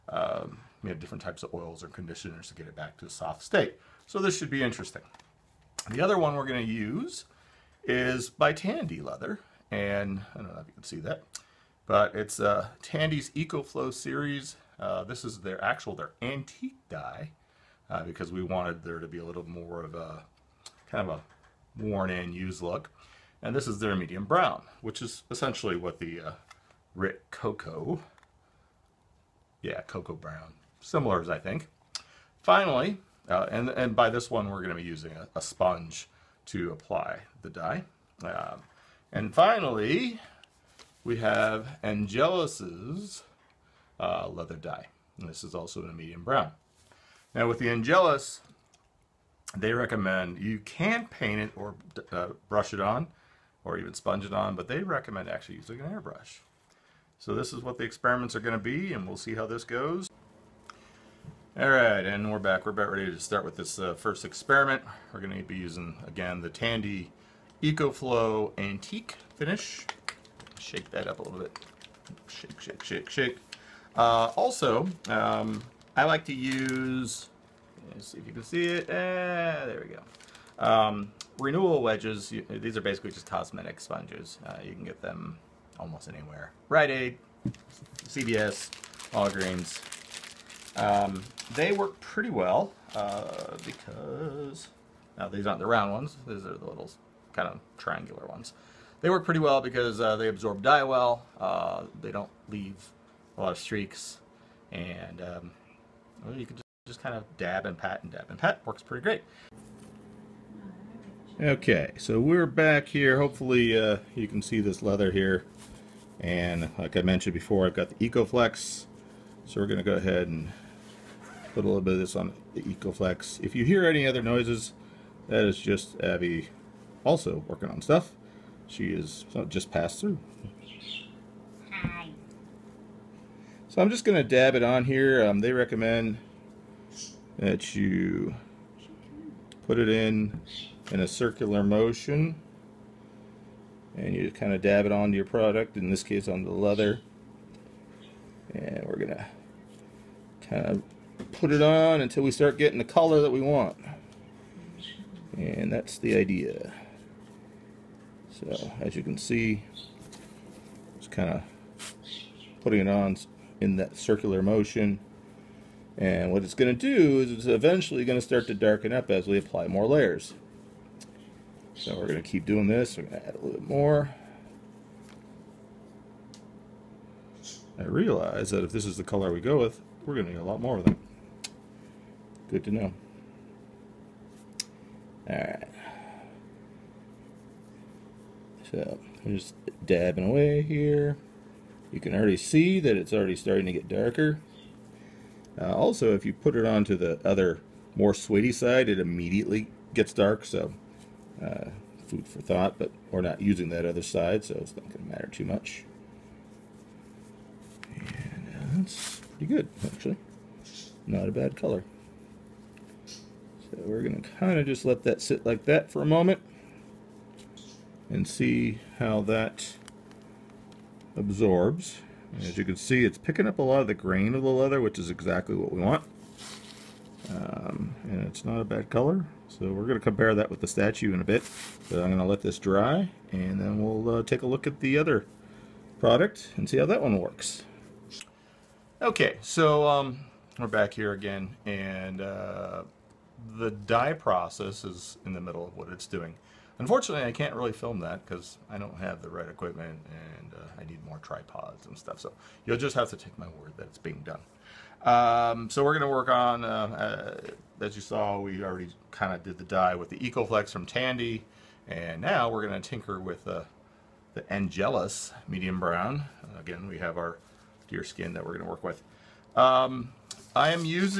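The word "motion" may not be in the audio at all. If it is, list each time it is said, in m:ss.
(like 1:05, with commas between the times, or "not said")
2:21, 2:44.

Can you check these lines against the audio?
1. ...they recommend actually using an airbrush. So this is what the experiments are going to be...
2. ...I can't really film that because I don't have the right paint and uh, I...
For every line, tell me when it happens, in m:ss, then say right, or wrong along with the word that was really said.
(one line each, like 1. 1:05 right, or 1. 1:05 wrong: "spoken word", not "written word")
1. 0:54 right
2. 4:07 wrong: "equipment", not "paint".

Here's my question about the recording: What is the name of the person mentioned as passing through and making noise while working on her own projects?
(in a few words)
Abby.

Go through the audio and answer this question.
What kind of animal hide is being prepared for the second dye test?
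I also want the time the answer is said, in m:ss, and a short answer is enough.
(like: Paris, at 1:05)
deer skin, at 4:27.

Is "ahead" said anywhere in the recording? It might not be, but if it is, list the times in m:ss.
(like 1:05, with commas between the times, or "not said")
1:59.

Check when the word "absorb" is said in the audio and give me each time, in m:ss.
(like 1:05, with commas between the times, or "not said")
1:40, 3:41.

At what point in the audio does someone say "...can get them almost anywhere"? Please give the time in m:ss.
1:24.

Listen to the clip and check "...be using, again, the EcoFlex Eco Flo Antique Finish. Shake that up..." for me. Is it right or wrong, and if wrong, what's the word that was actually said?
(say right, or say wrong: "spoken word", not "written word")
wrong: "Tandy", not "EcoFlex".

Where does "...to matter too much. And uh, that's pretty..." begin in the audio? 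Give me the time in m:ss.
3:25.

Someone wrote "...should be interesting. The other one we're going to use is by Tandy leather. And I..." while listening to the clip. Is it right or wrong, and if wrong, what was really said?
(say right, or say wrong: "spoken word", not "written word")
right.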